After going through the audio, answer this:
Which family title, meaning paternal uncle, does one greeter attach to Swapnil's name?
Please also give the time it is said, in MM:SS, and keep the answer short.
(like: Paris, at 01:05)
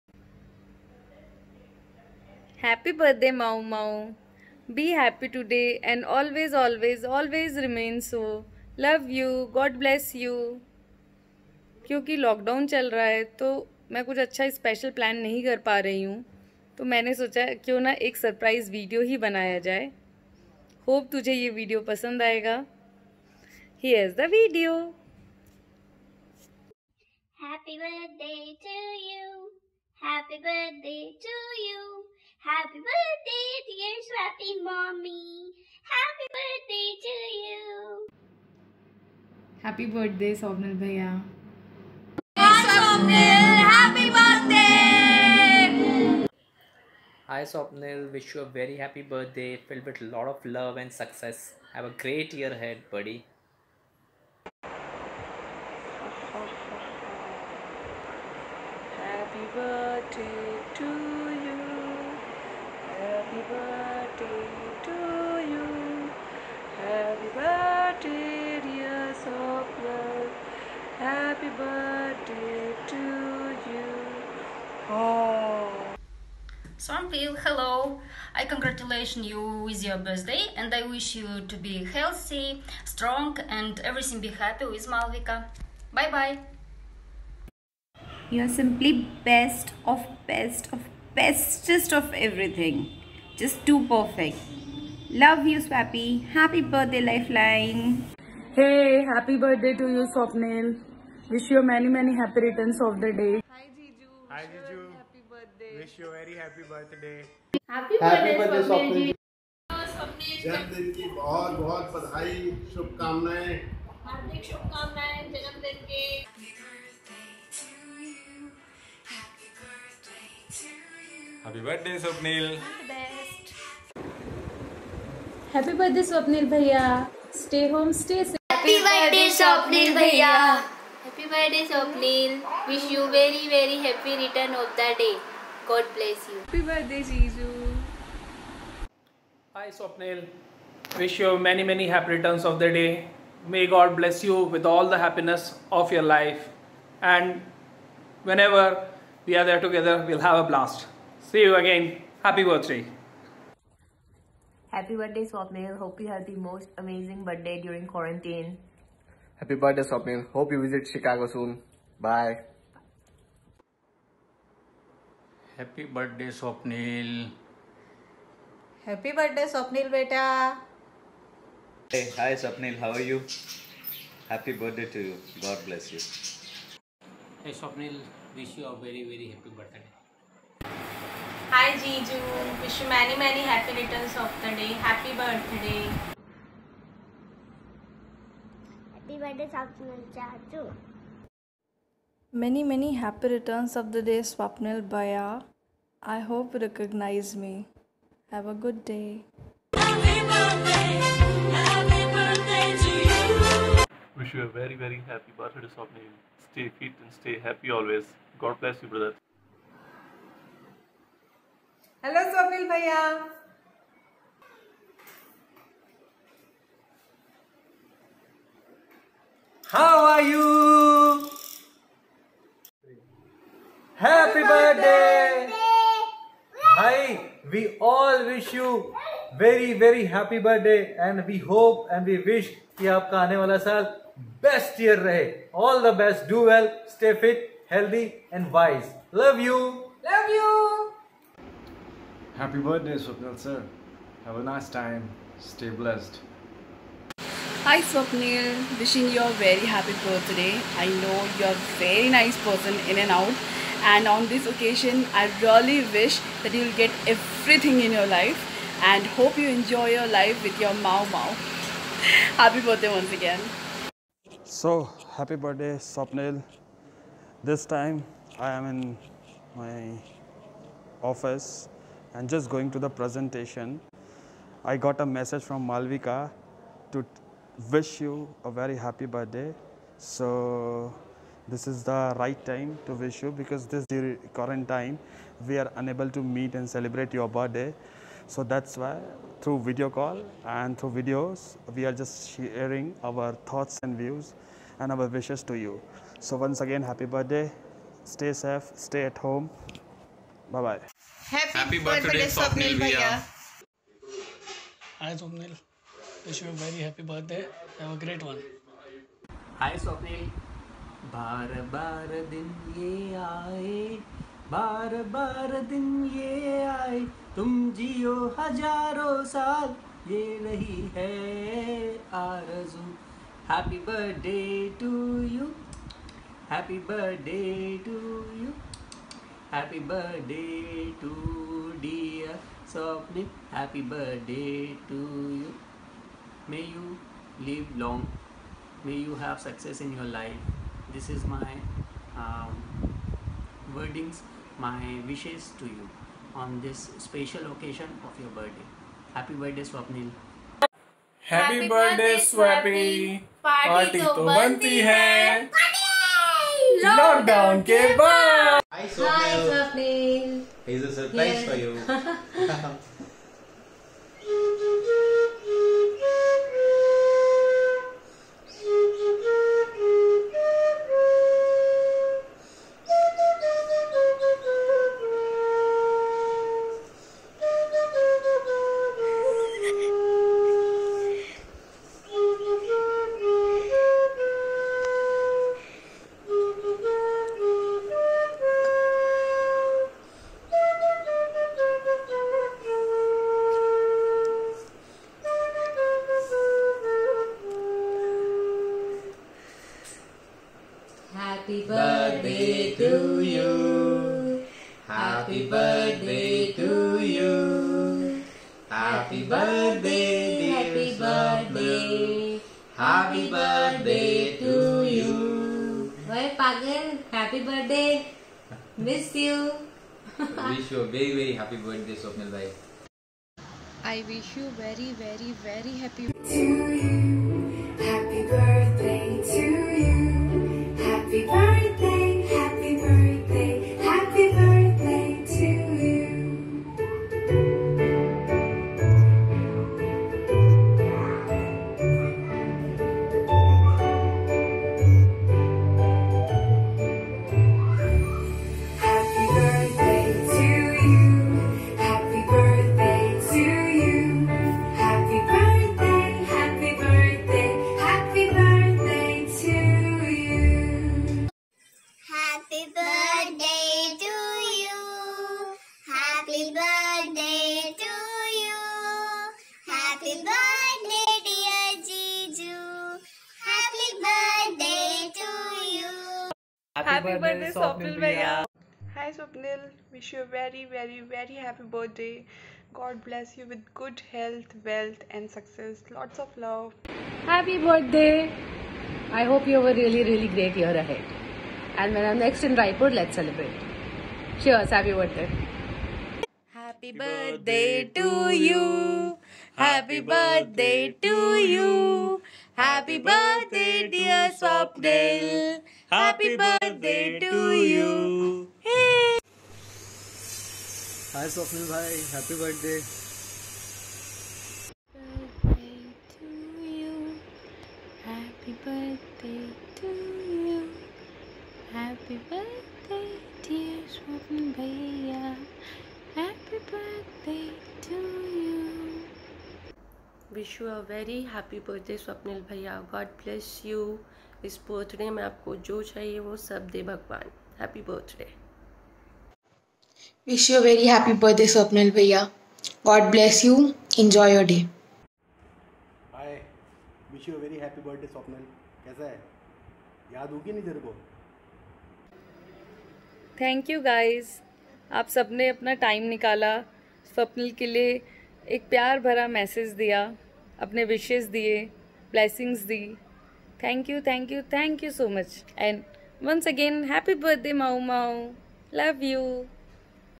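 Chachu, at 03:10.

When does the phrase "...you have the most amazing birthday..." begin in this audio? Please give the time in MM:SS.
02:35.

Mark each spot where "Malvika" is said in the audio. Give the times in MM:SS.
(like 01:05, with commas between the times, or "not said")
01:24, 04:35.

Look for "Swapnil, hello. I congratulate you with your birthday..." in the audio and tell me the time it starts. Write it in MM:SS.
01:16.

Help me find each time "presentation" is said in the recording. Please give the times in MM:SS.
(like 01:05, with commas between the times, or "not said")
04:32.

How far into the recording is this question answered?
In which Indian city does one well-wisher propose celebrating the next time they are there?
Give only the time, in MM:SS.
08:12.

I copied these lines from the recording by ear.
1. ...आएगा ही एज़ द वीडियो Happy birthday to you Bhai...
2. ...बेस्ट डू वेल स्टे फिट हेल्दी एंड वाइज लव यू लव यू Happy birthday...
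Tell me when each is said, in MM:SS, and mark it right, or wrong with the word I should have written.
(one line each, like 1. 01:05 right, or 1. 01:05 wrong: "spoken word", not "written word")
1. 00:22 wrong: "Happy", not "Bhai"
2. 03:56 right.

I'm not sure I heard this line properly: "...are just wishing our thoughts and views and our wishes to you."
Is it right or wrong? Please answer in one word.
wrong.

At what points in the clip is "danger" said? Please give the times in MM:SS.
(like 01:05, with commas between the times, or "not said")
not said.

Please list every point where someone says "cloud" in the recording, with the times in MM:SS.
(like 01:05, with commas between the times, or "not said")
not said.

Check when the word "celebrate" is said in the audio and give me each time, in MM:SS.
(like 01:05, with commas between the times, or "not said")
04:46, 08:13.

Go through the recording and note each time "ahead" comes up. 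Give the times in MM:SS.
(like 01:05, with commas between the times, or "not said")
00:52, 08:10.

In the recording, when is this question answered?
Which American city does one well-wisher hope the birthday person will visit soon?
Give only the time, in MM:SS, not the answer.
02:40.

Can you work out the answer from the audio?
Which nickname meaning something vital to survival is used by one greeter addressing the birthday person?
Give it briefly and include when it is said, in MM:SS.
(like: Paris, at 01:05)
Lifeline, at 01:37.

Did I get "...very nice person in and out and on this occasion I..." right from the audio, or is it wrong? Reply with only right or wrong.
right.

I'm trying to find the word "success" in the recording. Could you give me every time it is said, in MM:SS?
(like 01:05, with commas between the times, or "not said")
00:50, 05:39, 08:05.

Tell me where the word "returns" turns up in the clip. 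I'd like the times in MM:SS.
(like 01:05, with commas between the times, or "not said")
01:42, 02:22, 03:03, 03:13.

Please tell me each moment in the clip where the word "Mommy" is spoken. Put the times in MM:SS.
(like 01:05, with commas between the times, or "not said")
00:34.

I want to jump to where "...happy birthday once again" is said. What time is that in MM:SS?
04:22.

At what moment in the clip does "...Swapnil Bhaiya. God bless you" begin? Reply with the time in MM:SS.
08:52.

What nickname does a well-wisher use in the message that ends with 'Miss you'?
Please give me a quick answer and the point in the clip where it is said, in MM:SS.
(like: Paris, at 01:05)
Pagan, at 06:56.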